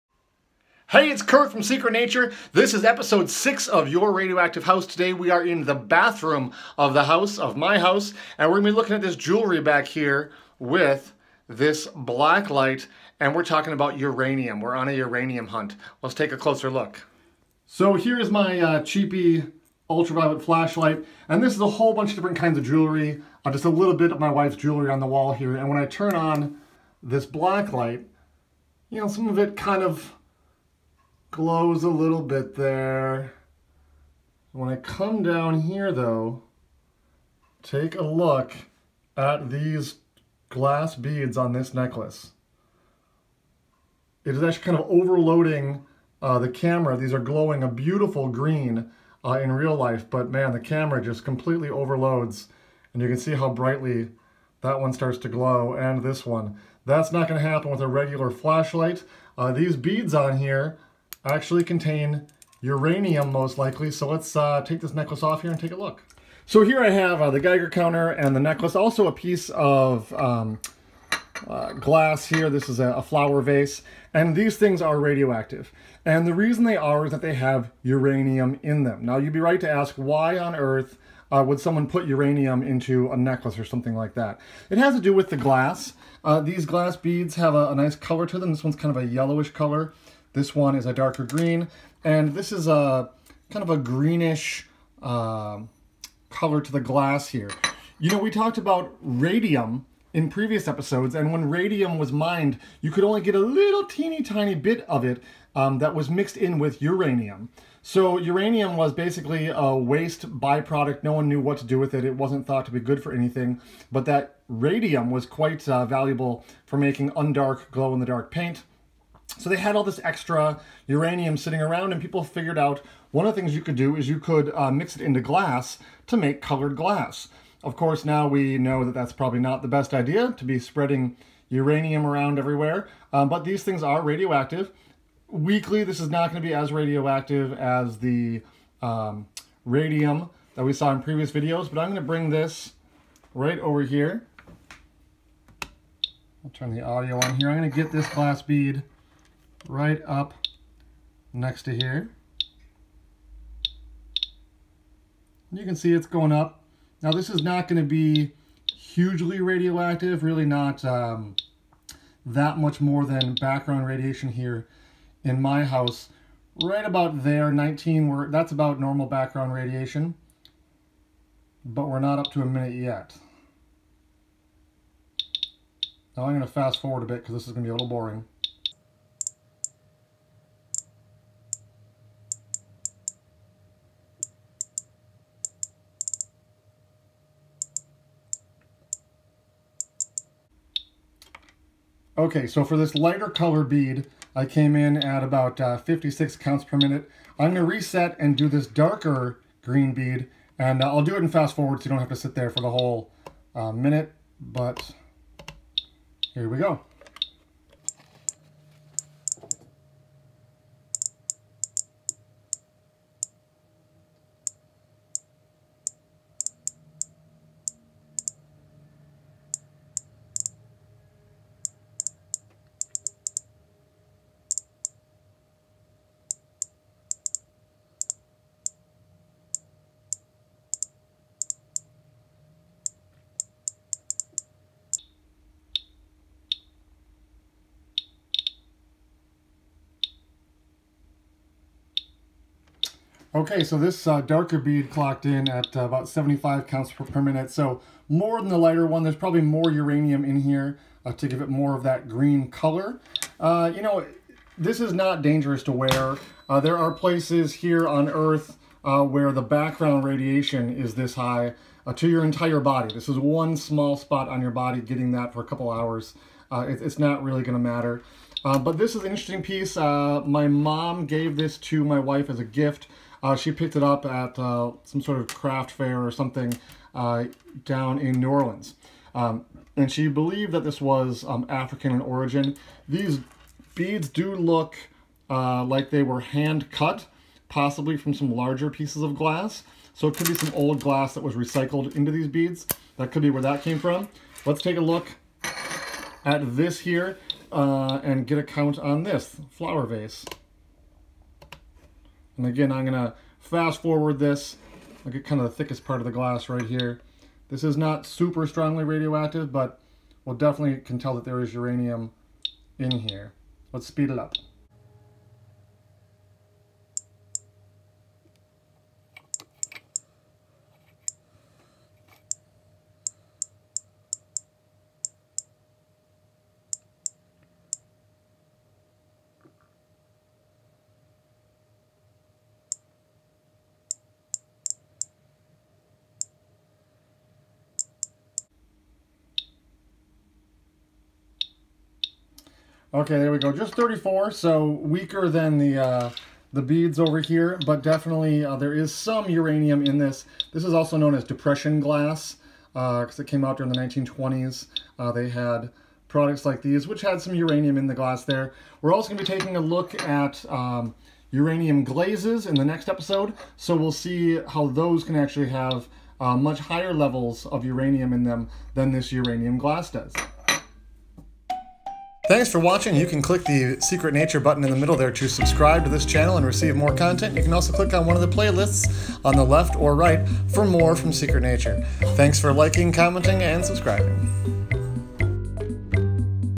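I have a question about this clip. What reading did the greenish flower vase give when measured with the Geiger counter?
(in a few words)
34.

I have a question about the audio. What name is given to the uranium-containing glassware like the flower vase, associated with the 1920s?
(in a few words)
depression glass.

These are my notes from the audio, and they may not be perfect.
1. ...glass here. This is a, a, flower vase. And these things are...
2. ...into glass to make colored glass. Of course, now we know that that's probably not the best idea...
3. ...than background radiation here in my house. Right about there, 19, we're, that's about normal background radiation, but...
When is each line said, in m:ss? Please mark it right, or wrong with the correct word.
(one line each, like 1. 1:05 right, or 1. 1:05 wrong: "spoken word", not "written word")
1. 1:11 right
2. 2:05 right
3. 2:43 right.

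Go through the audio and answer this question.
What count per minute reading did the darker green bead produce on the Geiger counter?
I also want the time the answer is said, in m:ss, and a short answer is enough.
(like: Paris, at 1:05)
75, at 4:06.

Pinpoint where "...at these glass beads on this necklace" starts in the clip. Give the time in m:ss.
0:39.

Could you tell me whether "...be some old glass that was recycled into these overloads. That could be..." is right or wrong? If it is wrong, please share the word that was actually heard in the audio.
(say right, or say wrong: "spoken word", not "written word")
wrong: "beads", not "overloads".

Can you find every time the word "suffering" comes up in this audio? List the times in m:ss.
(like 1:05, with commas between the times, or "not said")
not said.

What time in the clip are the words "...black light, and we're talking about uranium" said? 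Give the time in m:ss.
0:11.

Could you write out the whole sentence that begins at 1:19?
Now you'd be right to ask why on earth uh, would someone put uranium into a necklace or something like that?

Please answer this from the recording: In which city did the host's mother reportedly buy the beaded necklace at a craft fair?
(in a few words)
New Orleans.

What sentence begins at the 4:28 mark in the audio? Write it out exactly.
but this is an interesting piece.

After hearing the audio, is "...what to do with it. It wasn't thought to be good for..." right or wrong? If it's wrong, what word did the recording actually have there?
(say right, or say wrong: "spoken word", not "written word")
right.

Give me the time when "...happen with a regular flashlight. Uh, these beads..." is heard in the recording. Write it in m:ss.
0:57.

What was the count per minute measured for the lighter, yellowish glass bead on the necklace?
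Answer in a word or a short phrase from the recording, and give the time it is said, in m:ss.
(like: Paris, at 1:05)
56, at 3:15.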